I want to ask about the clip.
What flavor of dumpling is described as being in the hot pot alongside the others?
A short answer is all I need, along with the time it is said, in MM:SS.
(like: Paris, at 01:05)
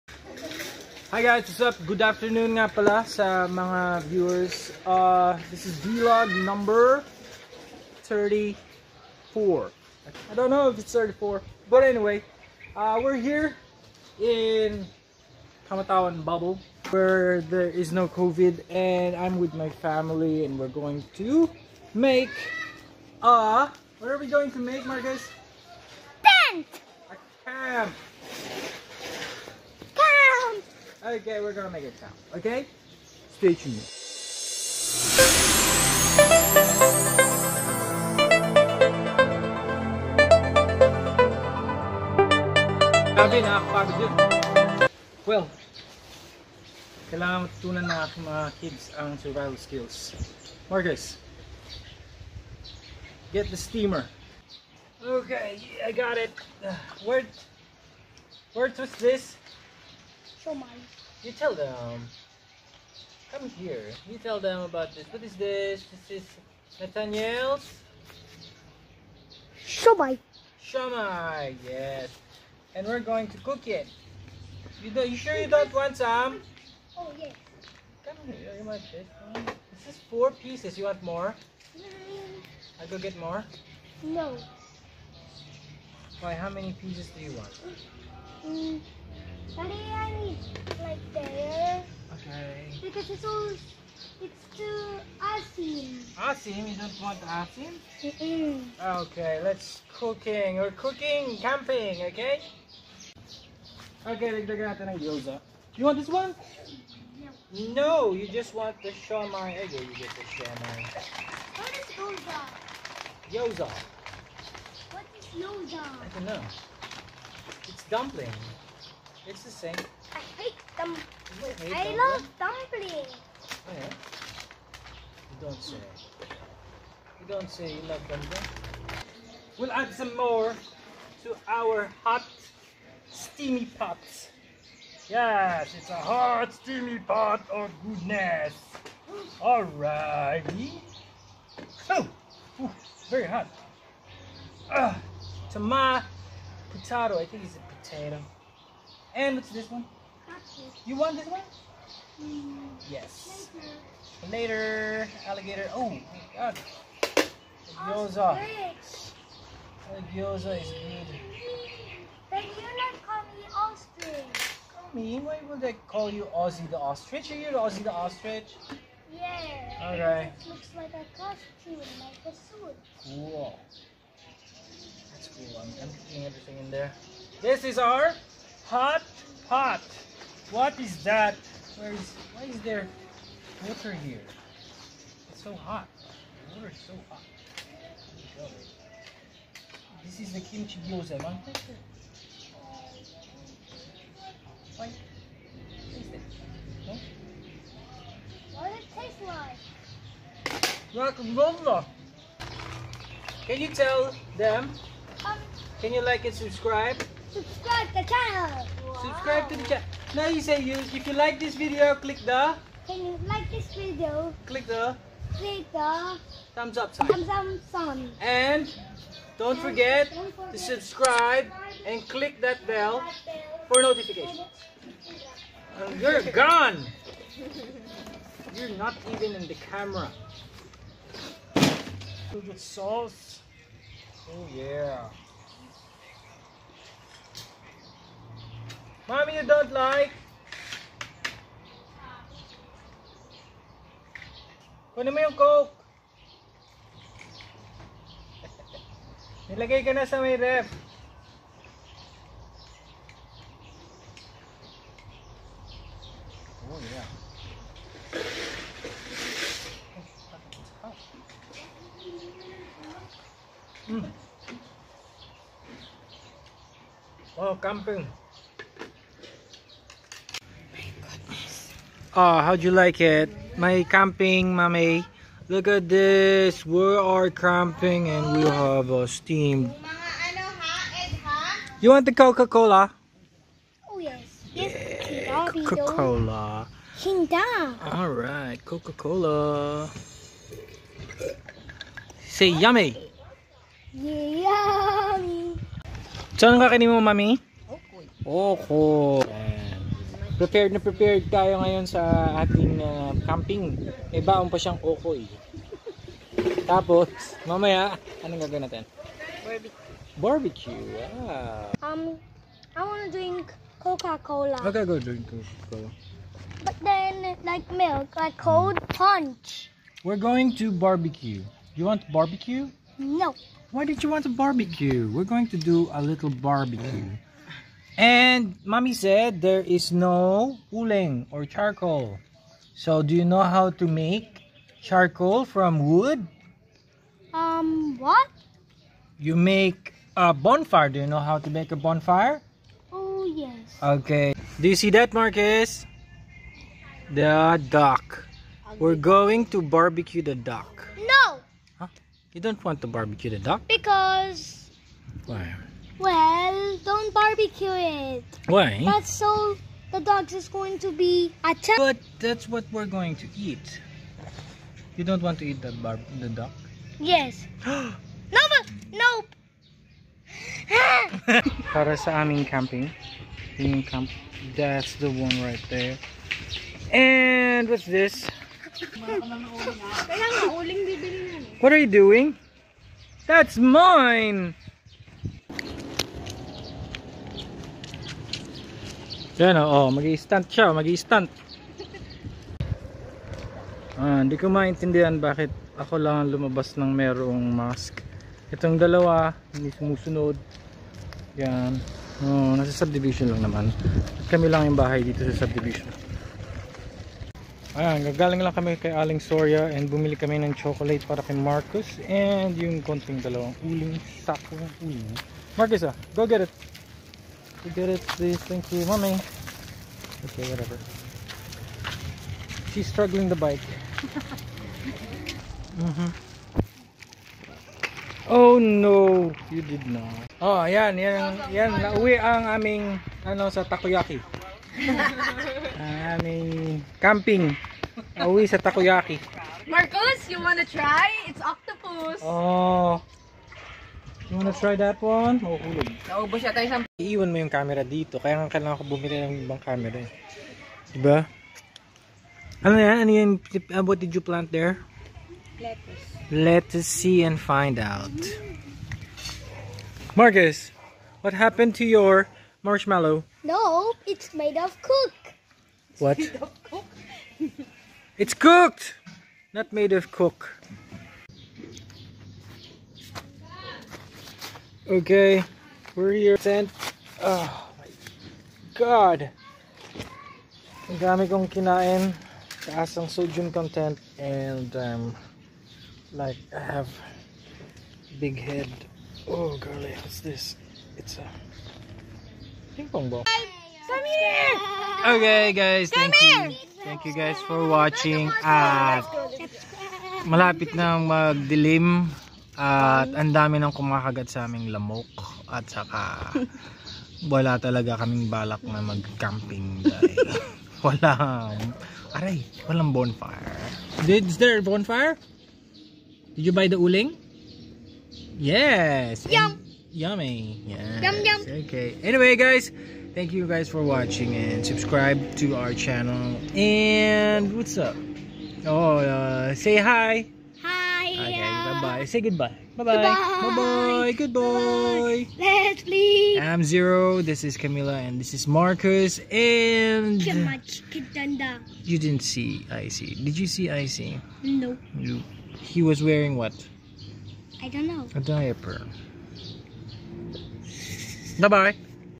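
Kimchi gyoza, at 03:10.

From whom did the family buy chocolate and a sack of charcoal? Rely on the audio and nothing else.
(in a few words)
Aling Soria.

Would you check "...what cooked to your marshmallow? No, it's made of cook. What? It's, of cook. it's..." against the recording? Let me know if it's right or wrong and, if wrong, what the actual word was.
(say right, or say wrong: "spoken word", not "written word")
wrong: "happened", not "cooked".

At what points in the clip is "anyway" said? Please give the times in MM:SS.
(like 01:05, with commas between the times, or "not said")
00:11, 08:42.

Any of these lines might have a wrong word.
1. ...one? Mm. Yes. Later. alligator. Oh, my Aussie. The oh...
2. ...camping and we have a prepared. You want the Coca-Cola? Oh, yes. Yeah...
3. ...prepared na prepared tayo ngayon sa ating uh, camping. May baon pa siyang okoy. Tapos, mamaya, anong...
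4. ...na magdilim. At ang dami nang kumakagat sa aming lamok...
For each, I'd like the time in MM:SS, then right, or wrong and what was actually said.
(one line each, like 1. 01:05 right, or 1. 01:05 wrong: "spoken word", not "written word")
1. 02:31 wrong: "God", not "Aussie"
2. 04:37 wrong: "steamed", not "prepared"
3. 05:00 right
4. 08:20 right.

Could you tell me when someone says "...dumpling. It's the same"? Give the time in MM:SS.
01:57.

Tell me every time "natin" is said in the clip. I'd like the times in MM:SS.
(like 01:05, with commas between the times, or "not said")
01:44, 05:08.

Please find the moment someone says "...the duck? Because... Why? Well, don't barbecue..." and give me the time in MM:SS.
05:53.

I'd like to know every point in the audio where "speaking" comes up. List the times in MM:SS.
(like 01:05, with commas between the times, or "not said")
not said.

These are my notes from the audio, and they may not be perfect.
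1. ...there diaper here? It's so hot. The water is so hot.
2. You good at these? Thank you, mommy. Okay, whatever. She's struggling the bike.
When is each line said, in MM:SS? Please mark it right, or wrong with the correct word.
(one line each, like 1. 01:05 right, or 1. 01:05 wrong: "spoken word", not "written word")
1. 03:02 wrong: "water", not "diaper"
2. 06:57 right.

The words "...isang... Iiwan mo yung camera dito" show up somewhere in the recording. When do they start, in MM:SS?
07:26.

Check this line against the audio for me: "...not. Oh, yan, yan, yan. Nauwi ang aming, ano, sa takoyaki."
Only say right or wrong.
right.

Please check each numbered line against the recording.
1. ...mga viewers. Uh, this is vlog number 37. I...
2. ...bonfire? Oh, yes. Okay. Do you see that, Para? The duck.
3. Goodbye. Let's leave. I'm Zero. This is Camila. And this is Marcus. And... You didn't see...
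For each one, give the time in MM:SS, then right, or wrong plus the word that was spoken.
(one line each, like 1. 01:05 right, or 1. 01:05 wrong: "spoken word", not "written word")
1. 00:03 wrong: "34", not "37"
2. 05:41 wrong: "Marcus", not "Para"
3. 08:54 right.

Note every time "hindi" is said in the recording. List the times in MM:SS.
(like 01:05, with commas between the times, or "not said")
06:34, 06:39.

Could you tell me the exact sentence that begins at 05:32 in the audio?
So do you know how to make charcoal from wood?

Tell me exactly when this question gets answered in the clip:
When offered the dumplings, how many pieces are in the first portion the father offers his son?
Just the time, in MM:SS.
01:20.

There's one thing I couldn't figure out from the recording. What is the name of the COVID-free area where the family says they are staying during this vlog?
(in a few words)
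Kamatawan bubble.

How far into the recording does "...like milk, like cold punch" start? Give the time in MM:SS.
05:17.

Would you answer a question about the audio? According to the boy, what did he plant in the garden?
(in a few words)
Lettuce.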